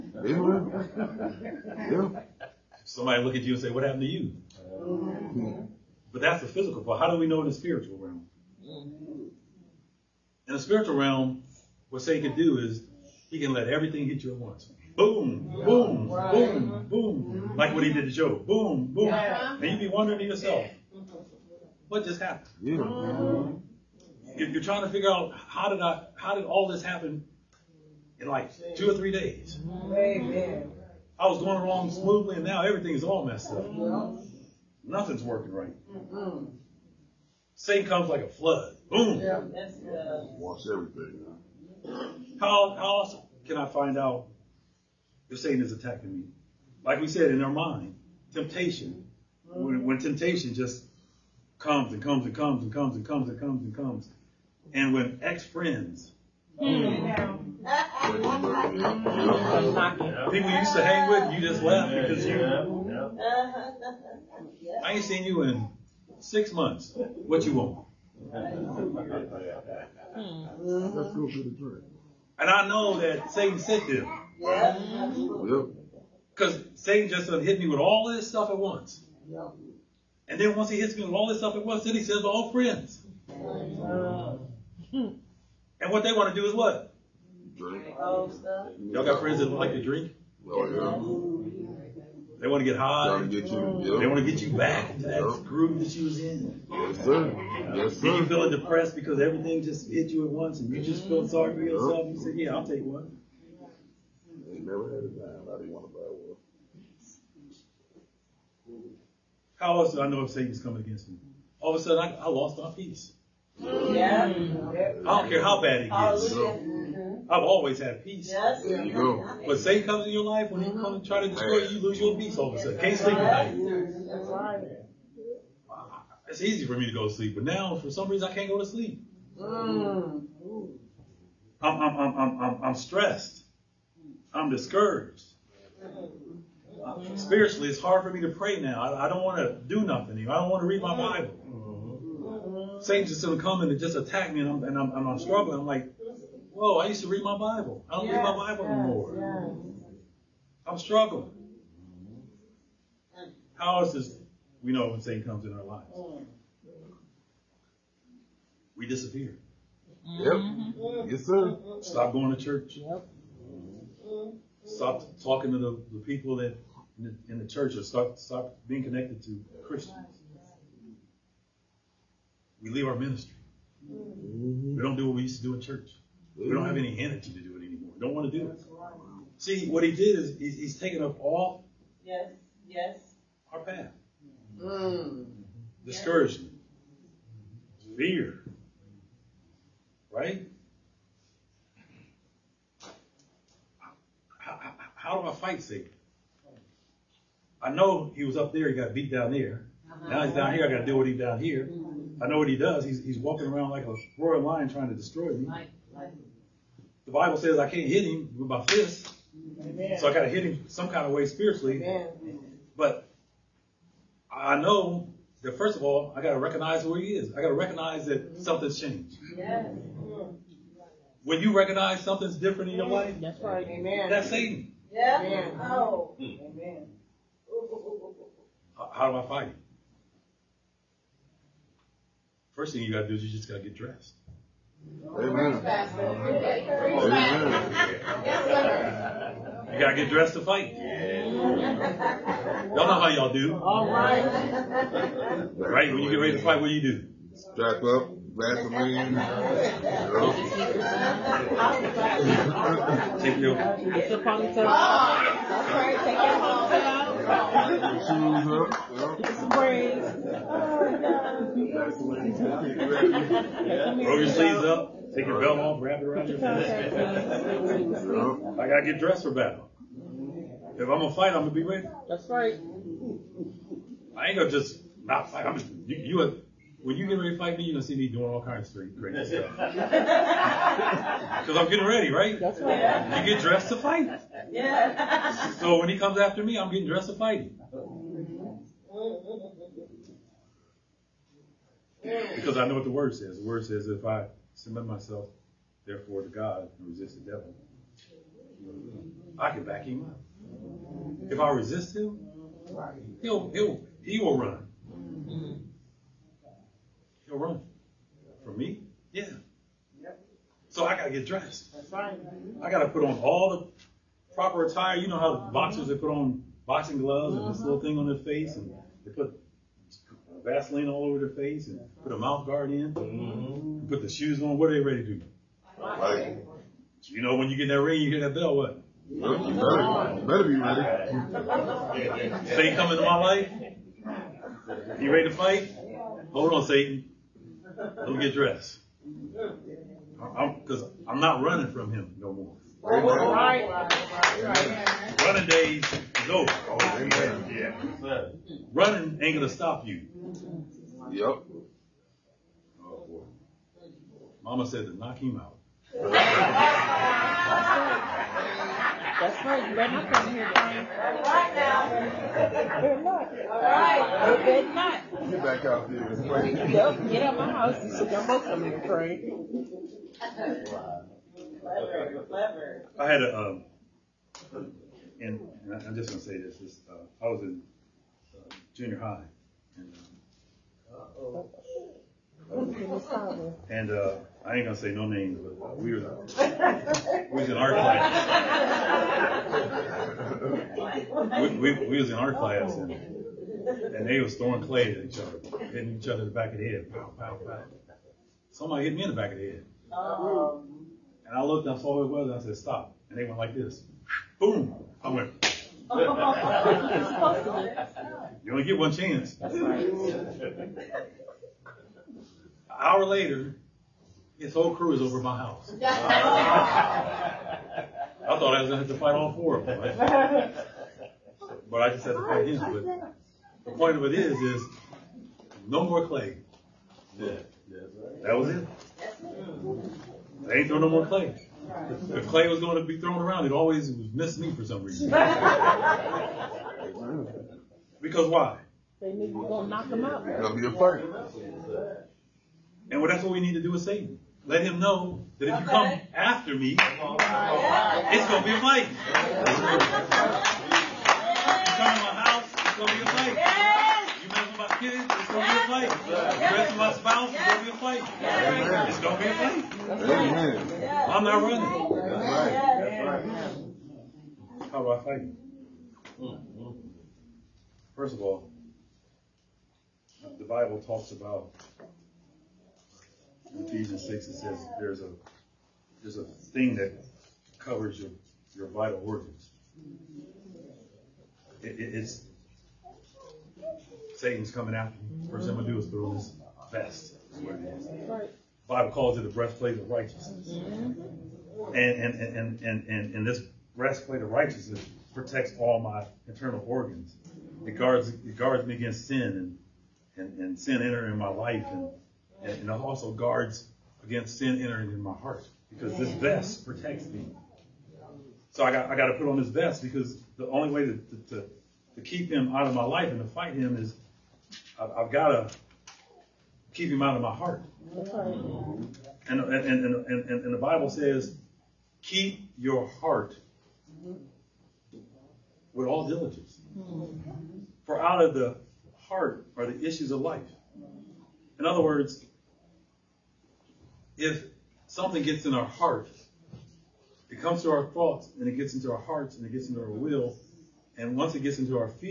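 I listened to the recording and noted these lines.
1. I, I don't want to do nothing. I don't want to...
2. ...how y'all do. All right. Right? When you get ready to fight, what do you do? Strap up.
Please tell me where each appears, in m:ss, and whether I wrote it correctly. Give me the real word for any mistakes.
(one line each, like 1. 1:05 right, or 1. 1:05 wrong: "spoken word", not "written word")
1. 2:18 right
2. 4:02 right.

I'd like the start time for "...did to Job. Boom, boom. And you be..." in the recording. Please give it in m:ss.
0:17.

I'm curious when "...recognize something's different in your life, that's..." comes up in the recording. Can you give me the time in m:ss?
3:41.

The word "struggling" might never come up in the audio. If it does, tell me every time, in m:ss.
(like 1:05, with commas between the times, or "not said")
2:25, 2:30.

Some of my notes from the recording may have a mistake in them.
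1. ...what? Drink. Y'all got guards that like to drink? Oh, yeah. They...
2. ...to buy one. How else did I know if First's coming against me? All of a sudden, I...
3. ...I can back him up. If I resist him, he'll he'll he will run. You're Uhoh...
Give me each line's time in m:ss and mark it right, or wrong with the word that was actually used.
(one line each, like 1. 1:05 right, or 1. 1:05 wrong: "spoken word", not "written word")
1. 1:26 wrong: "friends", not "guards"
2. 1:45 wrong: "Satan", not "First"
3. 4:59 wrong: "For", not "Uhoh".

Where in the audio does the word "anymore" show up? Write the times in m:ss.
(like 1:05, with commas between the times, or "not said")
2:28, 2:57.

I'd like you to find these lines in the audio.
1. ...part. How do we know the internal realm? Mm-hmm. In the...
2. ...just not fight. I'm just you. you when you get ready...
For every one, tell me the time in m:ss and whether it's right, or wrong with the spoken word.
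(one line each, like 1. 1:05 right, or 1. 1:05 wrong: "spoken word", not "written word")
1. 0:06 wrong: "spiritual", not "internal"
2. 4:34 right.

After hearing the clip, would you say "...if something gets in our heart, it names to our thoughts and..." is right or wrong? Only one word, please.
wrong.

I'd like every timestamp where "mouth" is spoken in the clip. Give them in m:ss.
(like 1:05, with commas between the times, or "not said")
5:22.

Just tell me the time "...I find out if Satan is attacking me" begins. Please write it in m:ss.
0:43.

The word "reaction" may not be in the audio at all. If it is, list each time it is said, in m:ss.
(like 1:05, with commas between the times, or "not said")
not said.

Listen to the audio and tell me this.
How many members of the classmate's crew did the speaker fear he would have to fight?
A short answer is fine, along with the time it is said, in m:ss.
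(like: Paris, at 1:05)
4, at 6:59.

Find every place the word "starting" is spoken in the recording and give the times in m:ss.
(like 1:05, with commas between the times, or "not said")
not said.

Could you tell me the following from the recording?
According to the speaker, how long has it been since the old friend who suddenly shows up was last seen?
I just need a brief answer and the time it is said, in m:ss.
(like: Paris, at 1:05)
6 months, at 1:06.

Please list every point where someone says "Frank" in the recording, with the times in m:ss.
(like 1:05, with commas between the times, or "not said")
6:08.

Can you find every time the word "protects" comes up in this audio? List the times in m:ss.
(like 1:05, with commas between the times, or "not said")
8:15, 8:26.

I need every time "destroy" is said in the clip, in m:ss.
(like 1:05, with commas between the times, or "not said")
2:01, 3:24.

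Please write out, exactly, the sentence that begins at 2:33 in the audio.
How else we know when Satan comes in our lives?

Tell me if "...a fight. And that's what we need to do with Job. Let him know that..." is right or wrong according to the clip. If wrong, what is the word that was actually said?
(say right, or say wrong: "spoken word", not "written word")
wrong: "Satan", not "Job".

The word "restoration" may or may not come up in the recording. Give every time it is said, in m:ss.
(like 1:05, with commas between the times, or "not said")
not said.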